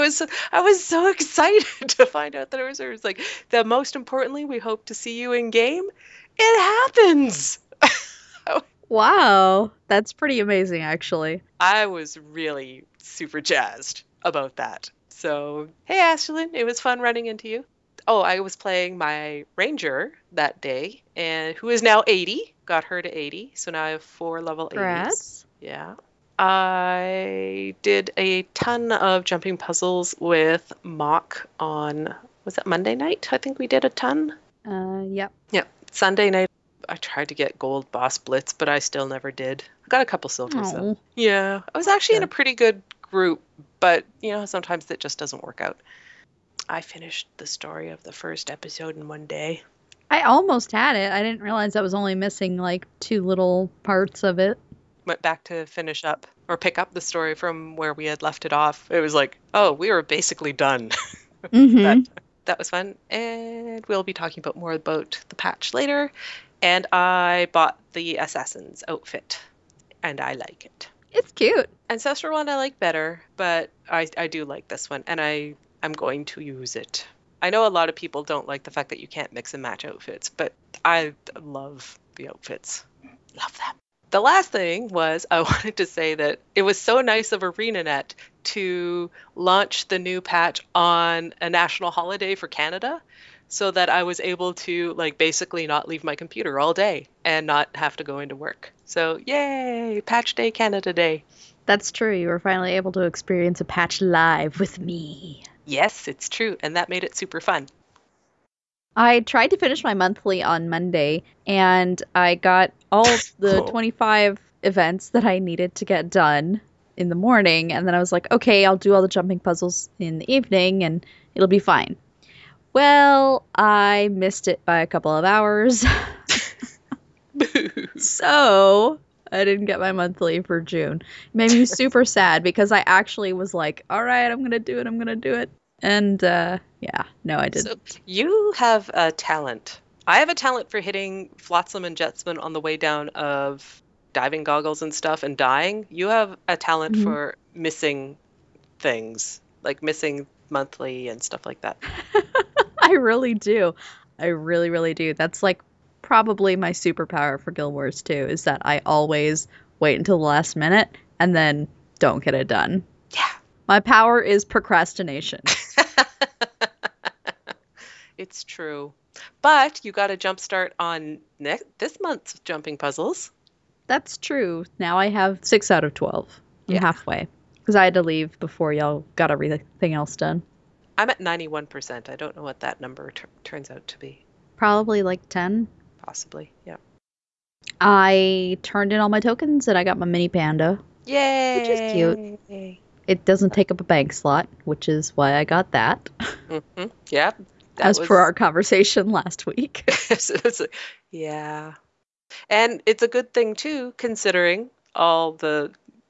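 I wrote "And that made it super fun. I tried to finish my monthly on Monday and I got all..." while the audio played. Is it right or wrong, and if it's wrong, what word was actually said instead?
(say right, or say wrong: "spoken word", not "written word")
right.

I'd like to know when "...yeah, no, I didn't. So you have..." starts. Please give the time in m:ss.
2:16.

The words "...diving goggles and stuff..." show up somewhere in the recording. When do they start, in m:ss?
2:24.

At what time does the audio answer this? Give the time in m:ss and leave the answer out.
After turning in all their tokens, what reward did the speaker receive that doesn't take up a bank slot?
3:10.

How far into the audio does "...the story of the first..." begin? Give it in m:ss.
0:47.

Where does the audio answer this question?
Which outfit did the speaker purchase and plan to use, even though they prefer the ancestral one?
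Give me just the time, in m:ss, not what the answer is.
1:08.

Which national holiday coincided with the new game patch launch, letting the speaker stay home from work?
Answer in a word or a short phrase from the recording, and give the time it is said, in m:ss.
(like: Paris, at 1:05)
Canada Day, at 1:40.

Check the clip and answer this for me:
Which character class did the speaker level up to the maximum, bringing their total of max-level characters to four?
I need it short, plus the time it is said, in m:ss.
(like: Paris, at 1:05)
ranger, at 0:19.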